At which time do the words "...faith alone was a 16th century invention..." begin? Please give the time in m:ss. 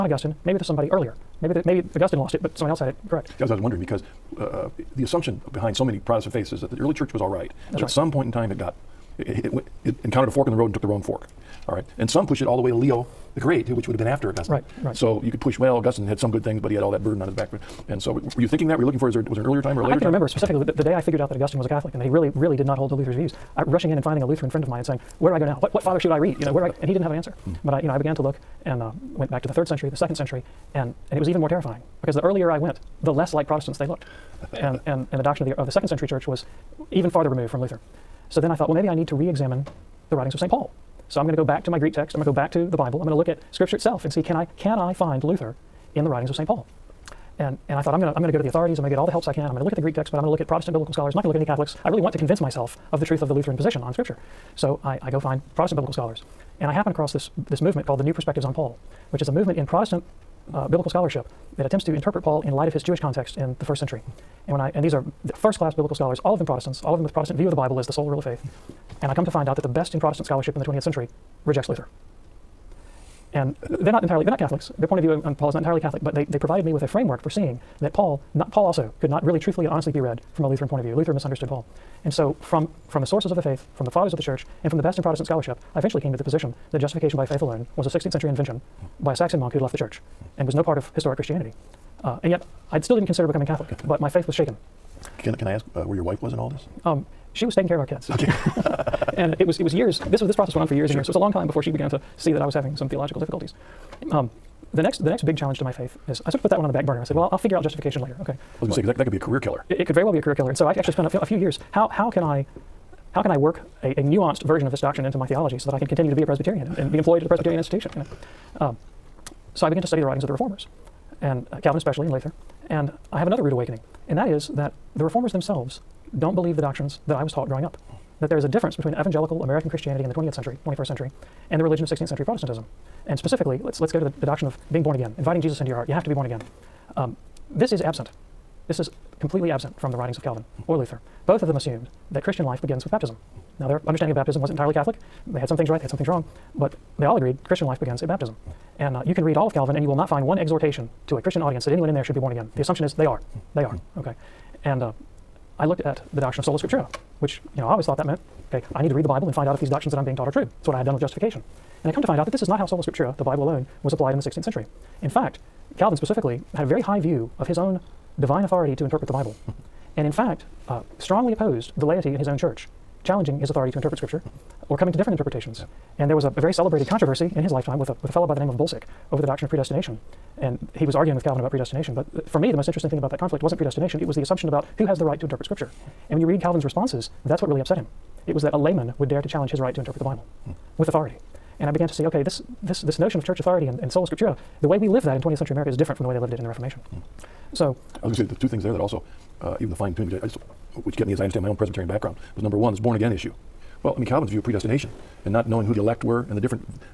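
1:27.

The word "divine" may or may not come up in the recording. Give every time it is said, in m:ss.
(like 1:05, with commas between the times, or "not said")
2:48.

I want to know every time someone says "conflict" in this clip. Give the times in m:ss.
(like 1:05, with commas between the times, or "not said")
3:03.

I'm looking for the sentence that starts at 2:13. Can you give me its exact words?
And specifically, let's, let's go to the, the doctrine of being born again, inviting Jesus into your heart.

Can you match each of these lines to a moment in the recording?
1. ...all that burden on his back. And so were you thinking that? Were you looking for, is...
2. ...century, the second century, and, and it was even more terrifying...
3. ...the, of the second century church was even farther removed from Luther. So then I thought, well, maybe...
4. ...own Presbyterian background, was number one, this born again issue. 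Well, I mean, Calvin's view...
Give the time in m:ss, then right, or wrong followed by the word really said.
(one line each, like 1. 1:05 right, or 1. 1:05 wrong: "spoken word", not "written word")
1. 0:16 right
2. 0:29 right
3. 0:35 right
4. 3:21 right.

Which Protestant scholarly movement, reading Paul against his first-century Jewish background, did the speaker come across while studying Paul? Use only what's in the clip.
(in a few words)
New Perspectives on Paul.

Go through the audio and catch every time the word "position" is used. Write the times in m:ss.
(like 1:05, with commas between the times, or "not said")
0:53, 1:26.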